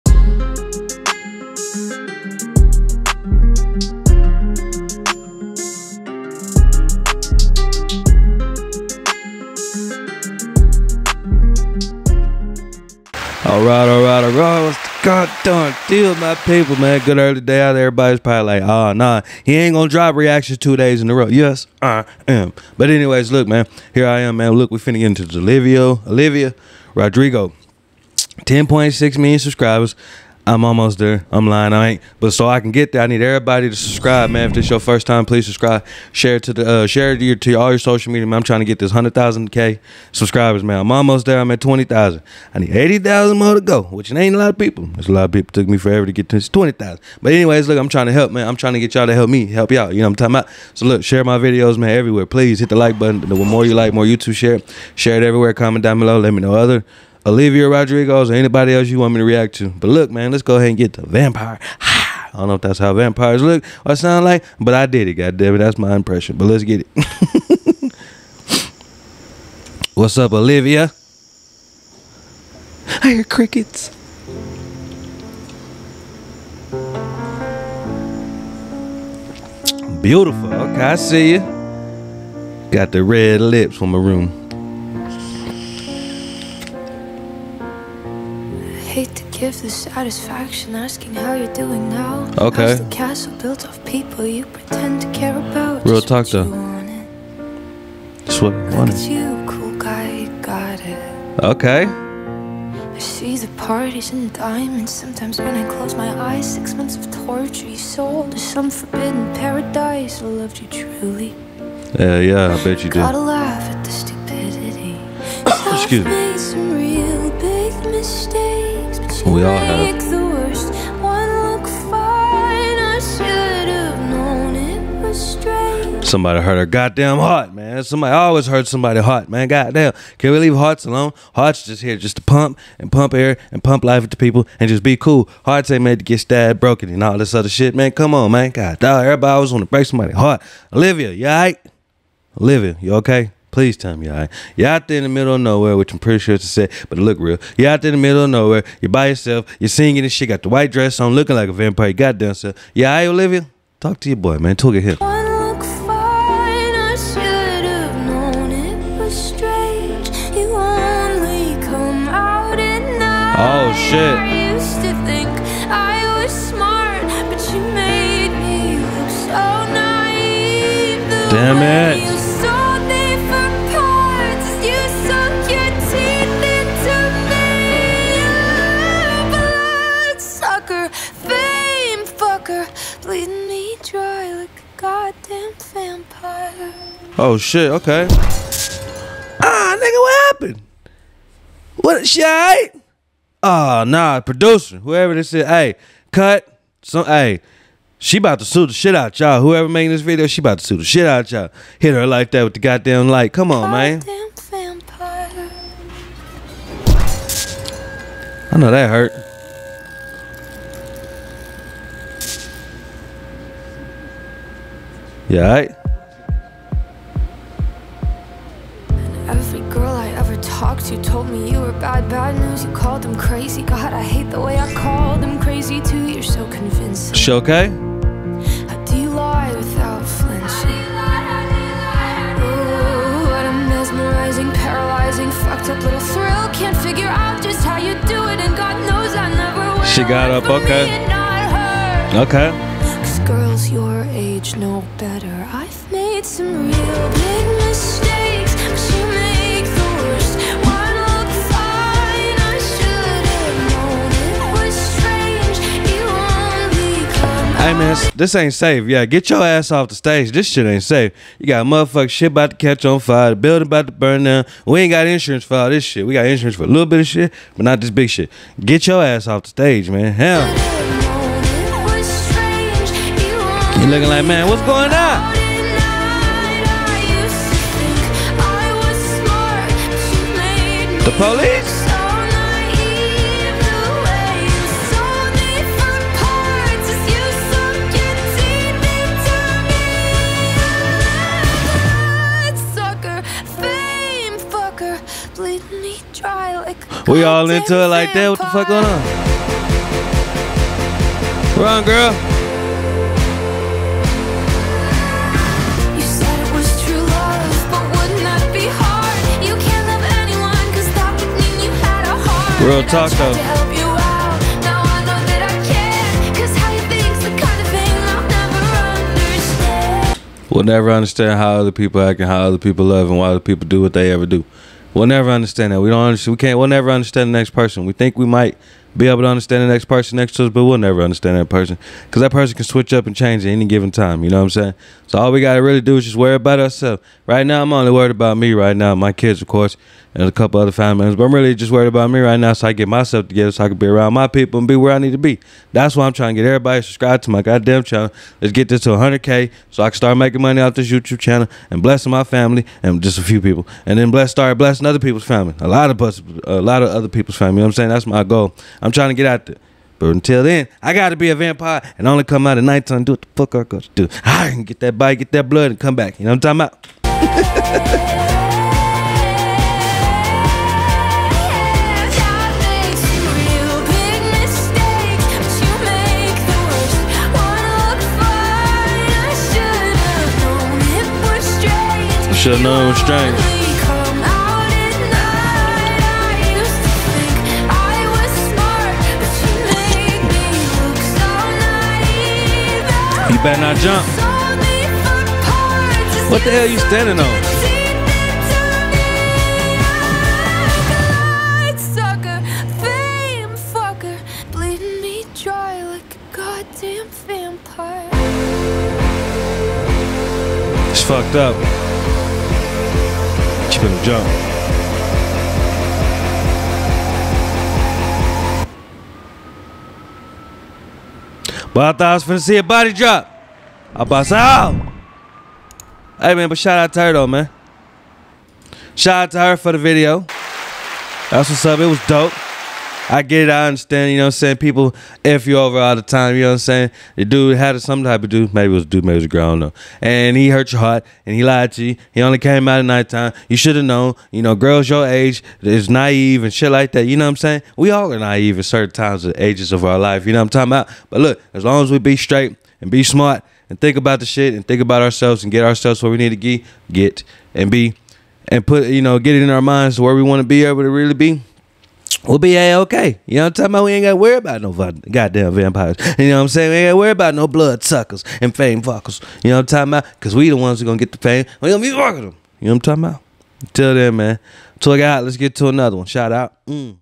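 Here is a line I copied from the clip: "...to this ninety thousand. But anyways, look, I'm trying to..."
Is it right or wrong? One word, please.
wrong.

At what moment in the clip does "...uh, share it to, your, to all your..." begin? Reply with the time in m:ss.
0:36.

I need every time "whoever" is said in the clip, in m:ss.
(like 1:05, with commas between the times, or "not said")
3:14, 3:19.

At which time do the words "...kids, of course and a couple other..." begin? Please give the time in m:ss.
5:39.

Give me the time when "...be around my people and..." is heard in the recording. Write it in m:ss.
5:43.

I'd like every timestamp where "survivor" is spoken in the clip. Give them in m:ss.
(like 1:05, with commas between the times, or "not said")
not said.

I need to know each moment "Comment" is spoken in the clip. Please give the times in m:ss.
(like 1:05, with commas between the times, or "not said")
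0:55.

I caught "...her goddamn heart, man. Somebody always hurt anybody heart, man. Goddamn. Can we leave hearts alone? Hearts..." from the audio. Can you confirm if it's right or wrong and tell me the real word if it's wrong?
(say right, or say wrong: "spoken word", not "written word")
wrong: "somebody", not "anybody".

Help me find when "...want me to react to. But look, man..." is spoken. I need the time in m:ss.
0:58.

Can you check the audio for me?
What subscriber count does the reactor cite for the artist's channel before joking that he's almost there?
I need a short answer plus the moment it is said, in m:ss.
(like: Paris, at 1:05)
10.6 million, at 0:28.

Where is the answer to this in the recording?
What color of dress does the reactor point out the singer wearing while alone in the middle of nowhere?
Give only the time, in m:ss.
2:30.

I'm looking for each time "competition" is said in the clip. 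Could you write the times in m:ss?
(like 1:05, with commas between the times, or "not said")
not said.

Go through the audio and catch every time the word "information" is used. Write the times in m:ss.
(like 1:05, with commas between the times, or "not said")
not said.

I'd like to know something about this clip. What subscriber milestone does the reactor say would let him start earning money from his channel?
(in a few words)
100k.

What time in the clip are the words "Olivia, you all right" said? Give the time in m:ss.
2:20.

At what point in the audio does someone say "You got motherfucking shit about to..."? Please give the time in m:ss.
4:21.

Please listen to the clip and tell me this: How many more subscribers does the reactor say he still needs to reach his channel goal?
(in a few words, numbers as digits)
80,000.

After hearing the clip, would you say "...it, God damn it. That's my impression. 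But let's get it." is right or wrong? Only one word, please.
right.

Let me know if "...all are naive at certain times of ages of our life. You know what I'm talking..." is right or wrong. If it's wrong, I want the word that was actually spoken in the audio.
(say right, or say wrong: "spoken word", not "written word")
right.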